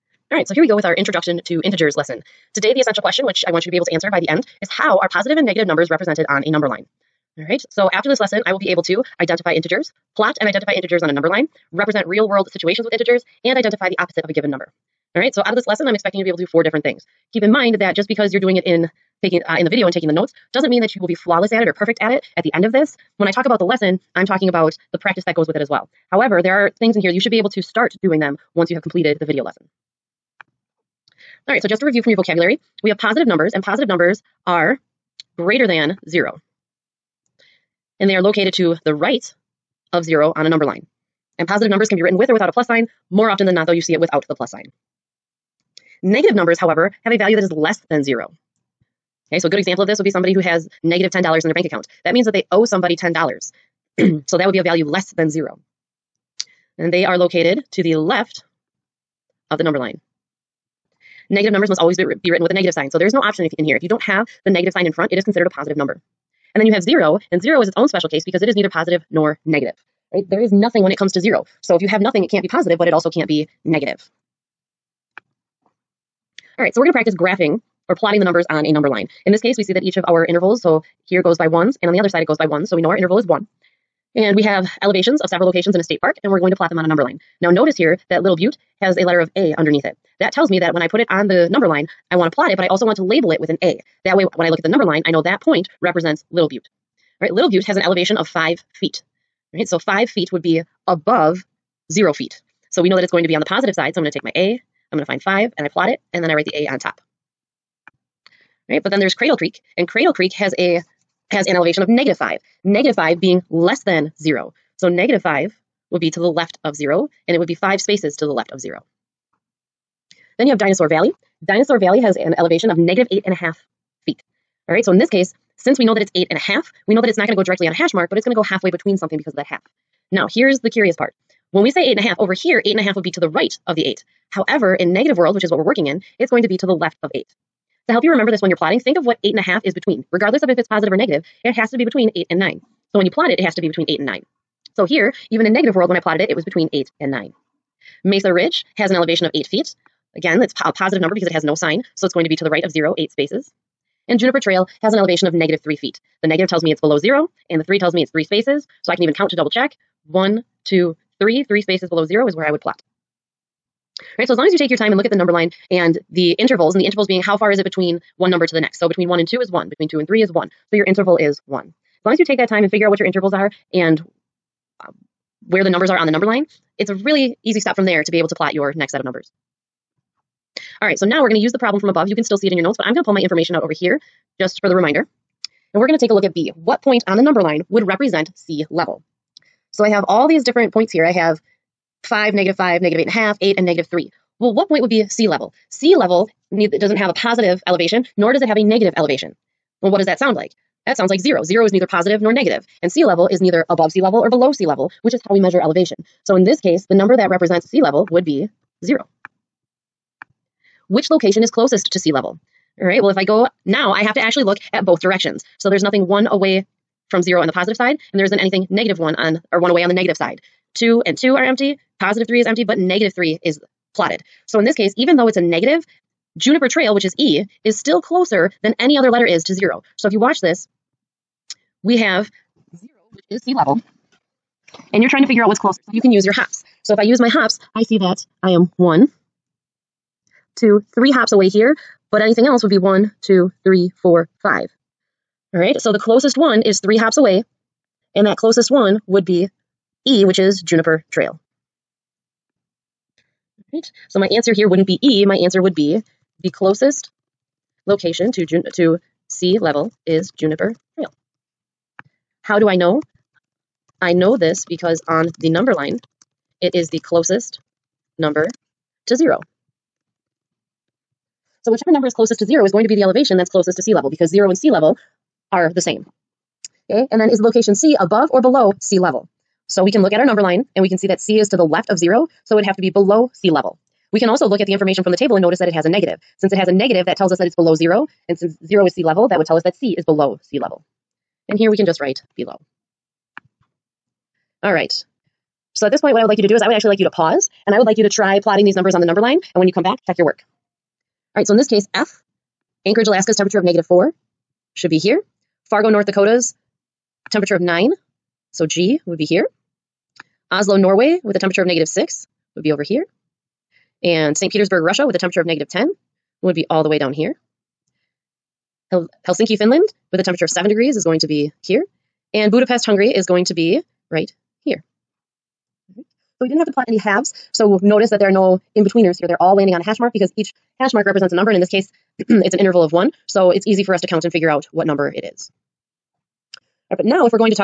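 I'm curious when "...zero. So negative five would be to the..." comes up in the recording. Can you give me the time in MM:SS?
01:54.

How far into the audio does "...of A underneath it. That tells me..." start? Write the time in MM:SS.
01:29.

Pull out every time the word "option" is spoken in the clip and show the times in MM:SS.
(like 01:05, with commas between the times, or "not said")
01:03.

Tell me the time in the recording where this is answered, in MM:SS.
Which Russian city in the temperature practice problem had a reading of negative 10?
05:14.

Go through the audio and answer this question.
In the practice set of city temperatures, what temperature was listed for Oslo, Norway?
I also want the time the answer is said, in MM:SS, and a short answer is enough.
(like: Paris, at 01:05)
-6, at 05:11.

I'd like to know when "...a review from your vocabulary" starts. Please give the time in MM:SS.
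00:31.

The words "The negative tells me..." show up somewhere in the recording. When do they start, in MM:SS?
02:36.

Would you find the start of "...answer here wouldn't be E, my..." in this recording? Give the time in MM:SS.
04:14.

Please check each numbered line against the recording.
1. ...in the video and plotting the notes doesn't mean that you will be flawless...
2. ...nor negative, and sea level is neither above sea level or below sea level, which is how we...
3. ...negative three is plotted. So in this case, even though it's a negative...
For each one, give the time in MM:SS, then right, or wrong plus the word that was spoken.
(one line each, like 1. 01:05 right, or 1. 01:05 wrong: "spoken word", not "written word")
1. 00:19 wrong: "taking", not "plotting"
2. 03:22 right
3. 03:42 right.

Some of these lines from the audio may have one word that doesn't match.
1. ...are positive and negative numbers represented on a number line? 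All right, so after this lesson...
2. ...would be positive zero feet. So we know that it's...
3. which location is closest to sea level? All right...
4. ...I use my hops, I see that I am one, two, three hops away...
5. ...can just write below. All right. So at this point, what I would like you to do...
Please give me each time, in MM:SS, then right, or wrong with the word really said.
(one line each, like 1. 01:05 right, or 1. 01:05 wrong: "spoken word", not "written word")
1. 00:04 right
2. 01:40 wrong: "above", not "positive"
3. 03:30 right
4. 03:56 right
5. 04:51 right.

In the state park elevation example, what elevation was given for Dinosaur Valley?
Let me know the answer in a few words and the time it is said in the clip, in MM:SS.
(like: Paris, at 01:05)
-8.5 feet, at 02:02.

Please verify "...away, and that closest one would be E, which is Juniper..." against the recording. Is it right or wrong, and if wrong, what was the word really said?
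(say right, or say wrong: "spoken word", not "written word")
right.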